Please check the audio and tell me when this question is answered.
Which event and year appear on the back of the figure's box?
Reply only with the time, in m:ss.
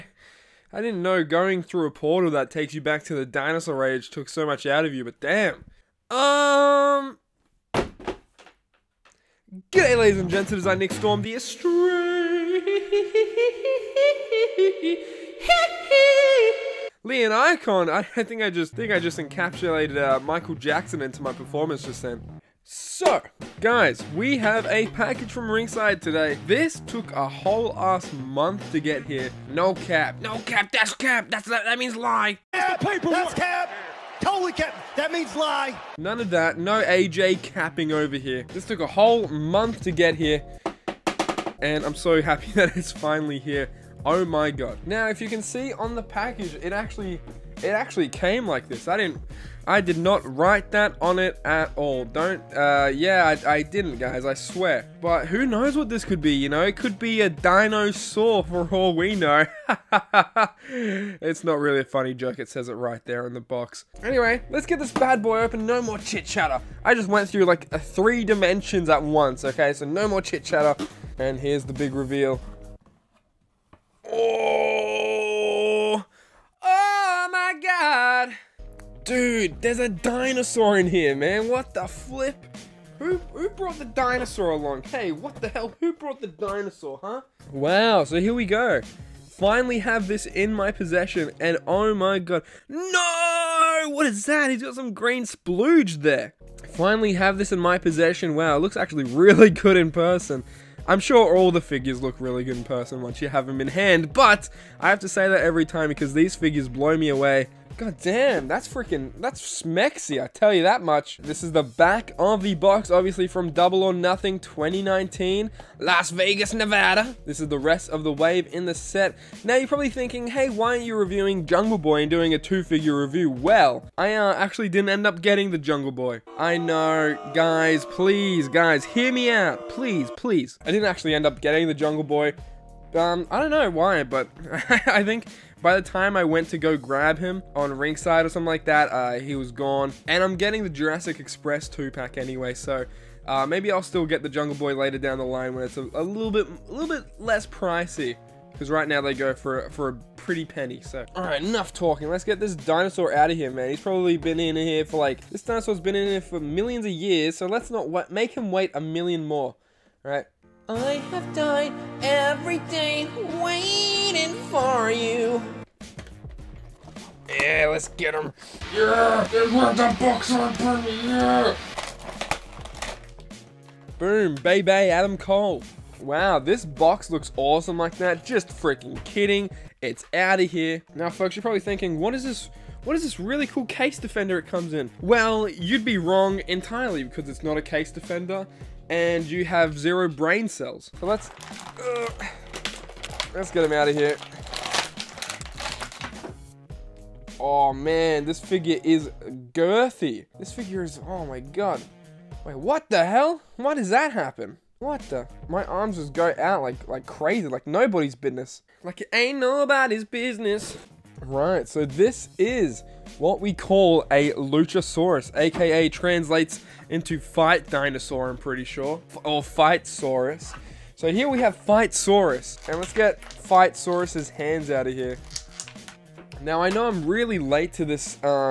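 1:53.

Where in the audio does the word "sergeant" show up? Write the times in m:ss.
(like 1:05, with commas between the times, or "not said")
not said.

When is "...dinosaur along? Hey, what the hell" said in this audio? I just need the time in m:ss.
1:23.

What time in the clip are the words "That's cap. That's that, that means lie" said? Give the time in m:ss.
0:30.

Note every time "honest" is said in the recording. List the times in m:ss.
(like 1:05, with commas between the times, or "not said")
not said.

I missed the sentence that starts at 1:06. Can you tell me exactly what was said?
I just went through like three dimensions at once, okay?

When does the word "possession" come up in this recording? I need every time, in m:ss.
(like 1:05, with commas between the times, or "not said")
1:30, 1:37.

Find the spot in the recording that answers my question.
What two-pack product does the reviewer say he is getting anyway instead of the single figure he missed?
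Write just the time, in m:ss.
2:20.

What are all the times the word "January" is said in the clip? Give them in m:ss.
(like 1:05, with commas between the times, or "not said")
not said.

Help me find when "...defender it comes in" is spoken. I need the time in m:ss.
3:03.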